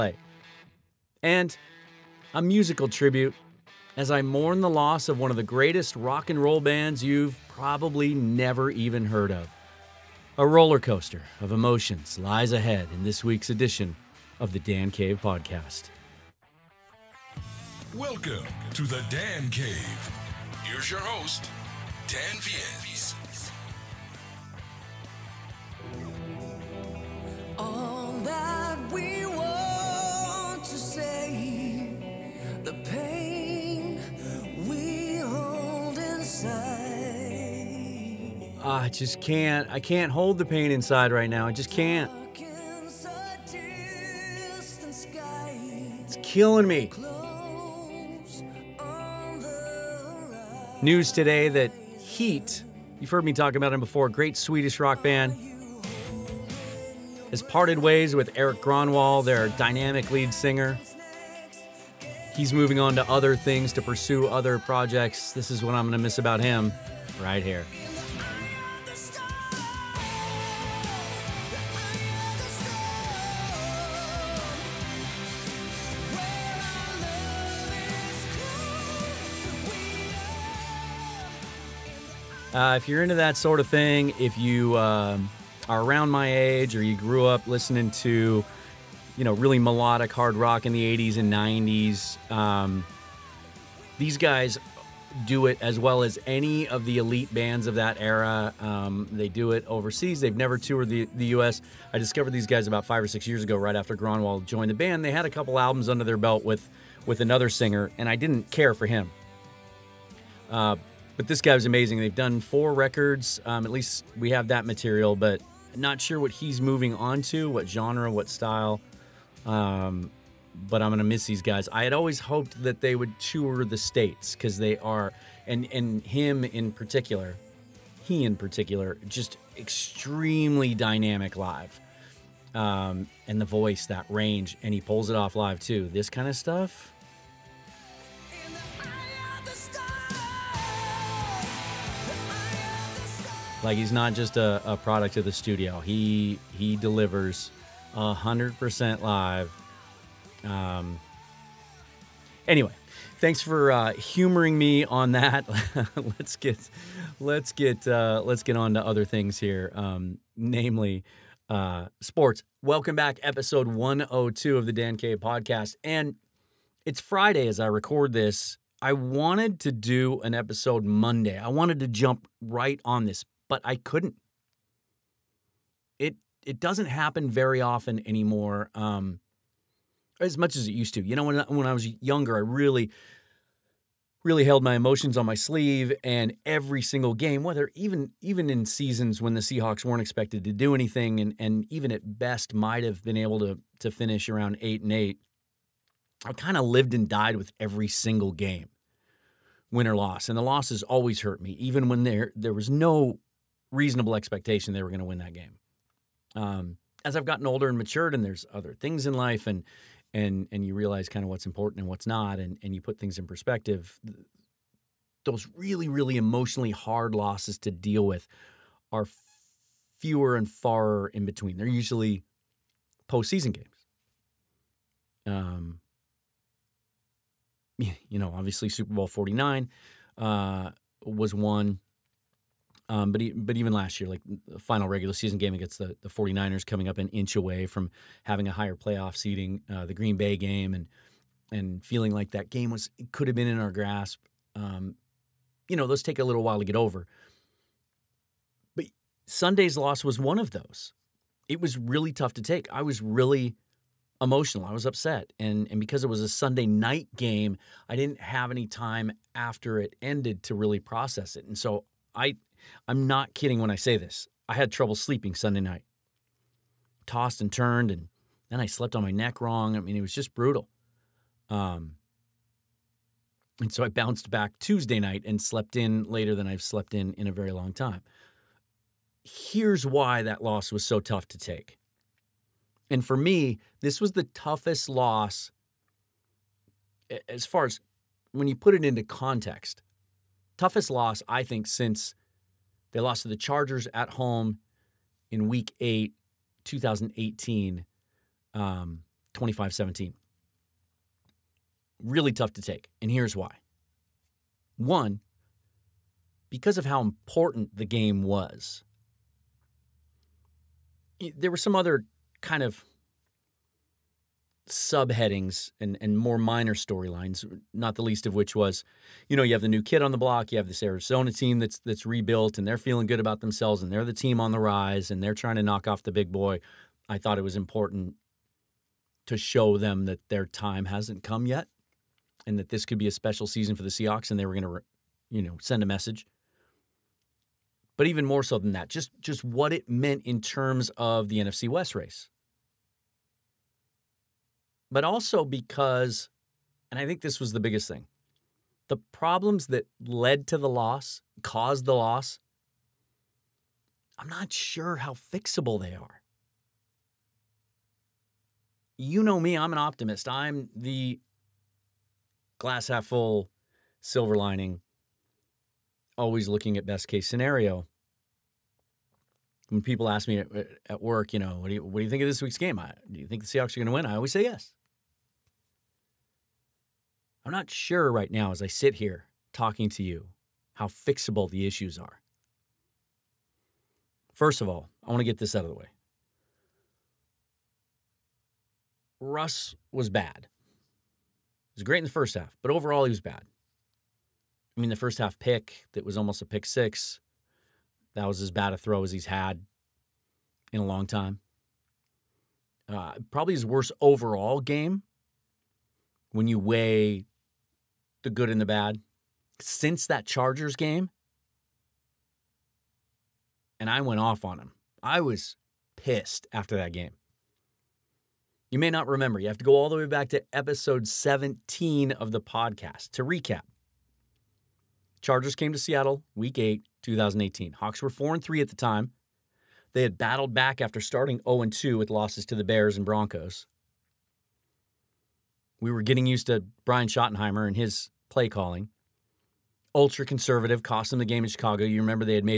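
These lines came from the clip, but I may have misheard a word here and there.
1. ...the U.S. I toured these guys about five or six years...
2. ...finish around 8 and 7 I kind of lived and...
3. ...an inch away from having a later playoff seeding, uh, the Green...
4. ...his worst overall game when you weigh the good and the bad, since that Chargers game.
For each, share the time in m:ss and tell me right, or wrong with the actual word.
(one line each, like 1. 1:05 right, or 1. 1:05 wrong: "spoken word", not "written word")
1. 1:41 wrong: "discovered", not "toured"
2. 3:13 wrong: "8", not "7"
3. 3:56 wrong: "higher", not "later"
4. 6:43 right.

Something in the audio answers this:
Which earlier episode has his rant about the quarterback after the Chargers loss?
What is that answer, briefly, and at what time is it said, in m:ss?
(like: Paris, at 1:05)
Episode 17, at 7:00.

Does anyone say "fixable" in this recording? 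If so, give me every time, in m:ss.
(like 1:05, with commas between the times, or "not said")
5:55, 6:20.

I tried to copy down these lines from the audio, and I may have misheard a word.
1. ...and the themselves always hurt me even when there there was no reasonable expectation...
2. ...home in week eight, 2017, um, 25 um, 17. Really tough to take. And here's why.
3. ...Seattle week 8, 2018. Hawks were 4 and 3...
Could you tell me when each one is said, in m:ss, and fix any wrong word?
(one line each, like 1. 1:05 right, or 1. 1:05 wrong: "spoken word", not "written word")
1. 3:20 wrong: "losses", not "themselves"
2. 4:54 wrong: "2018", not "2017"
3. 7:05 right.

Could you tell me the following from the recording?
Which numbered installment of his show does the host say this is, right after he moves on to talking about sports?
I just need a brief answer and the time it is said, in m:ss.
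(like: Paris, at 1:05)
102, at 2:43.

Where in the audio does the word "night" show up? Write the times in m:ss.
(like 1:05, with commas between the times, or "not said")
4:16, 4:25, 4:34.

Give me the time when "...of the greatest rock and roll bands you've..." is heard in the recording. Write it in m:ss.
0:05.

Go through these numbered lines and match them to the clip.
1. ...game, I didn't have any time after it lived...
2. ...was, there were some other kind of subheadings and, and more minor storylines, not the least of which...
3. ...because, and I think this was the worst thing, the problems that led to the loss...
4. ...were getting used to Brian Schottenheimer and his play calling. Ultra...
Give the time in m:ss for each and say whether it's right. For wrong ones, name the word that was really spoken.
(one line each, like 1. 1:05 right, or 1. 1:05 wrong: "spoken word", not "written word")
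1. 4:17 wrong: "ended", not "lived"
2. 5:08 right
3. 5:45 wrong: "biggest", not "worst"
4. 7:15 right.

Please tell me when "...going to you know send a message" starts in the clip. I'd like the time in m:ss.
5:34.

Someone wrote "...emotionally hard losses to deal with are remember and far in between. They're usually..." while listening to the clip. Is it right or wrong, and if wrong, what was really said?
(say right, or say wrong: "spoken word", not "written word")
wrong: "fewer", not "remember".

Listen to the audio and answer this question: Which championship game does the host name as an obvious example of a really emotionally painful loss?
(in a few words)
Super Bowl 49.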